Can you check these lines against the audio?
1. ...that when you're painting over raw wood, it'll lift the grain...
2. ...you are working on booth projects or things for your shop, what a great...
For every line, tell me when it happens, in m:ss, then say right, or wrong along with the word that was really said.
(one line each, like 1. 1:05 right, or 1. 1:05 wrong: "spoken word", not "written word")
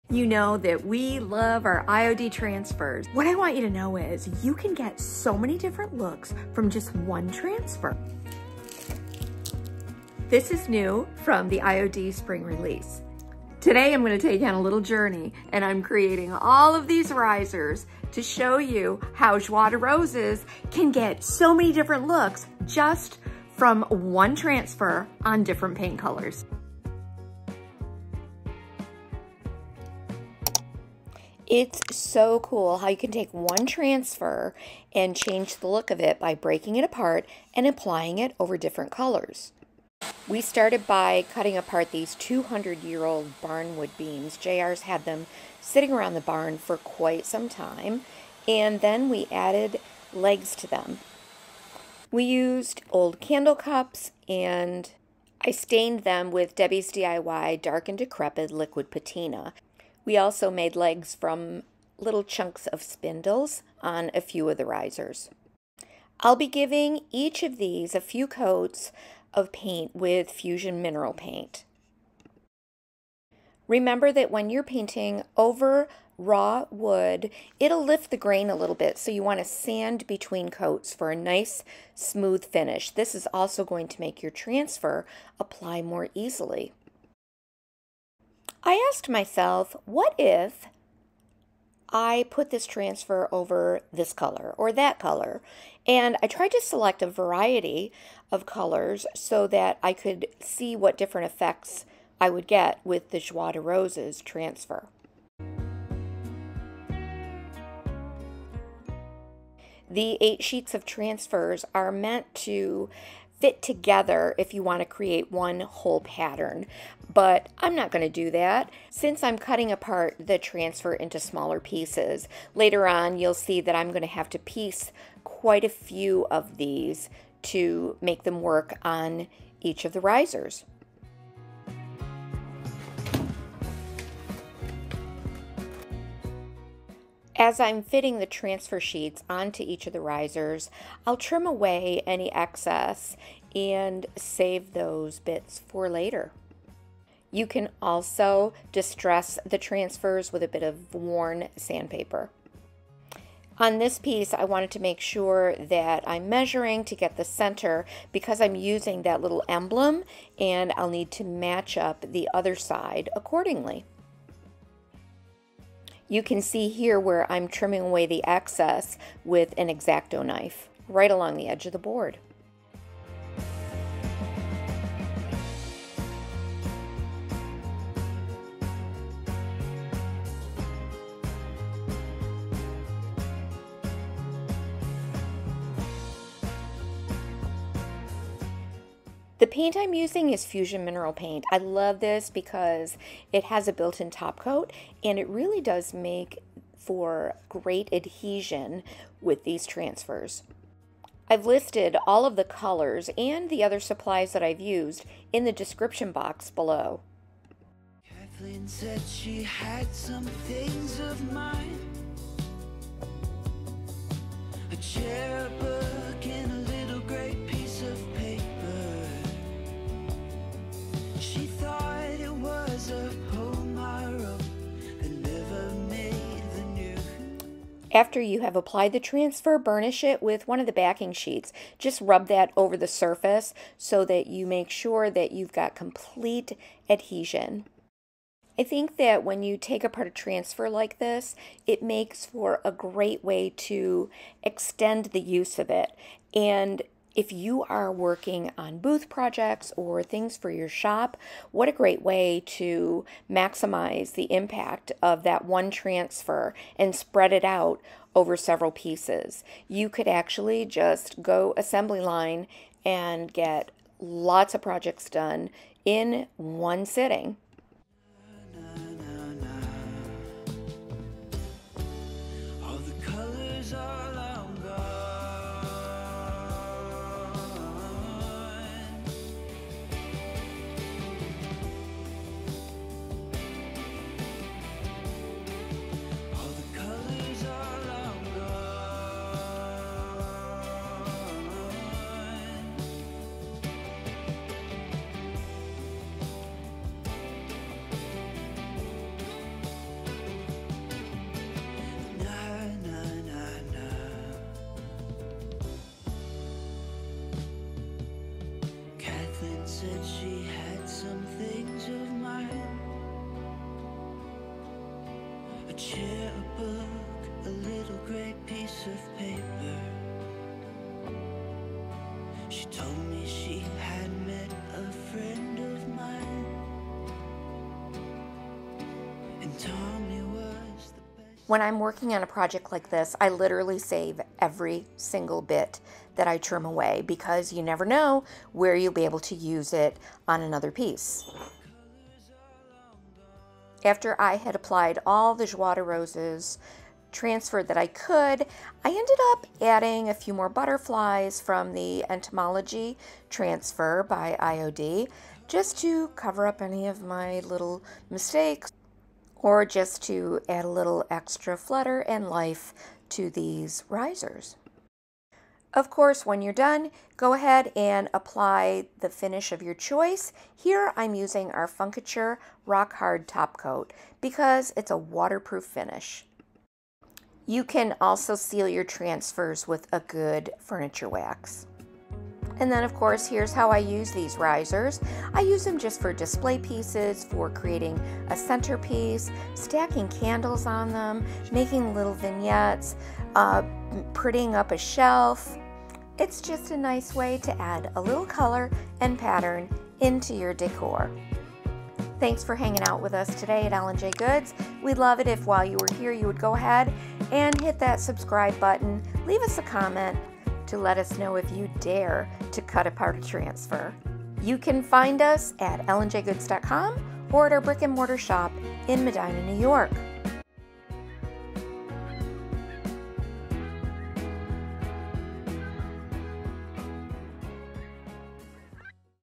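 1. 1:14 right
2. 4:07 right.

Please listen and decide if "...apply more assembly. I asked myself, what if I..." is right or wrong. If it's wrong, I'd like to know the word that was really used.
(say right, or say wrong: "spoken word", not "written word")
wrong: "easily", not "assembly".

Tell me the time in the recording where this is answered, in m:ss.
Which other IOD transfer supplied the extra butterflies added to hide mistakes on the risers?
5:52.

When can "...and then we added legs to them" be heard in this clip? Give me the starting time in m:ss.
0:48.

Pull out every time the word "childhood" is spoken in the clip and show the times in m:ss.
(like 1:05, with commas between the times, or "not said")
not said.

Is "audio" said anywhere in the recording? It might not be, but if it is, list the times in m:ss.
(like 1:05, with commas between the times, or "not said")
not said.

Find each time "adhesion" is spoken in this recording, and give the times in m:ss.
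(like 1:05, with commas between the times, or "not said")
3:17, 3:56.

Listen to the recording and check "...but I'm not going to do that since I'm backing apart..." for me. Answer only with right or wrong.
wrong.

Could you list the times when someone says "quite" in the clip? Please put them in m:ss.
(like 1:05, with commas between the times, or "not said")
0:46, 2:05.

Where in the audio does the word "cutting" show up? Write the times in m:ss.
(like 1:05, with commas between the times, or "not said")
0:41, 1:59.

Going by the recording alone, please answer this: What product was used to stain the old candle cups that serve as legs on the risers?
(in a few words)
Dark and Decrepit Liquid Patina.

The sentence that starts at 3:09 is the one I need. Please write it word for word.
The paint I'm using is Fusion Mineral Paint.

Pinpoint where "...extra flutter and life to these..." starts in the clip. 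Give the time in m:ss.
6:01.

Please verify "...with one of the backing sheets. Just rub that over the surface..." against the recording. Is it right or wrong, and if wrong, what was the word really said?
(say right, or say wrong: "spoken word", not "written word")
right.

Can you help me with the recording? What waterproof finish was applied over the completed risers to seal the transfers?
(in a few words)
Funkiture Rock Hard Top Coat.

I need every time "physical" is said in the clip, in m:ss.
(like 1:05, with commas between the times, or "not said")
not said.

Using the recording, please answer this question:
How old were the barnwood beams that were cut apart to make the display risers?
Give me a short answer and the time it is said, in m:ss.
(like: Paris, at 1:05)
200 years, at 0:42.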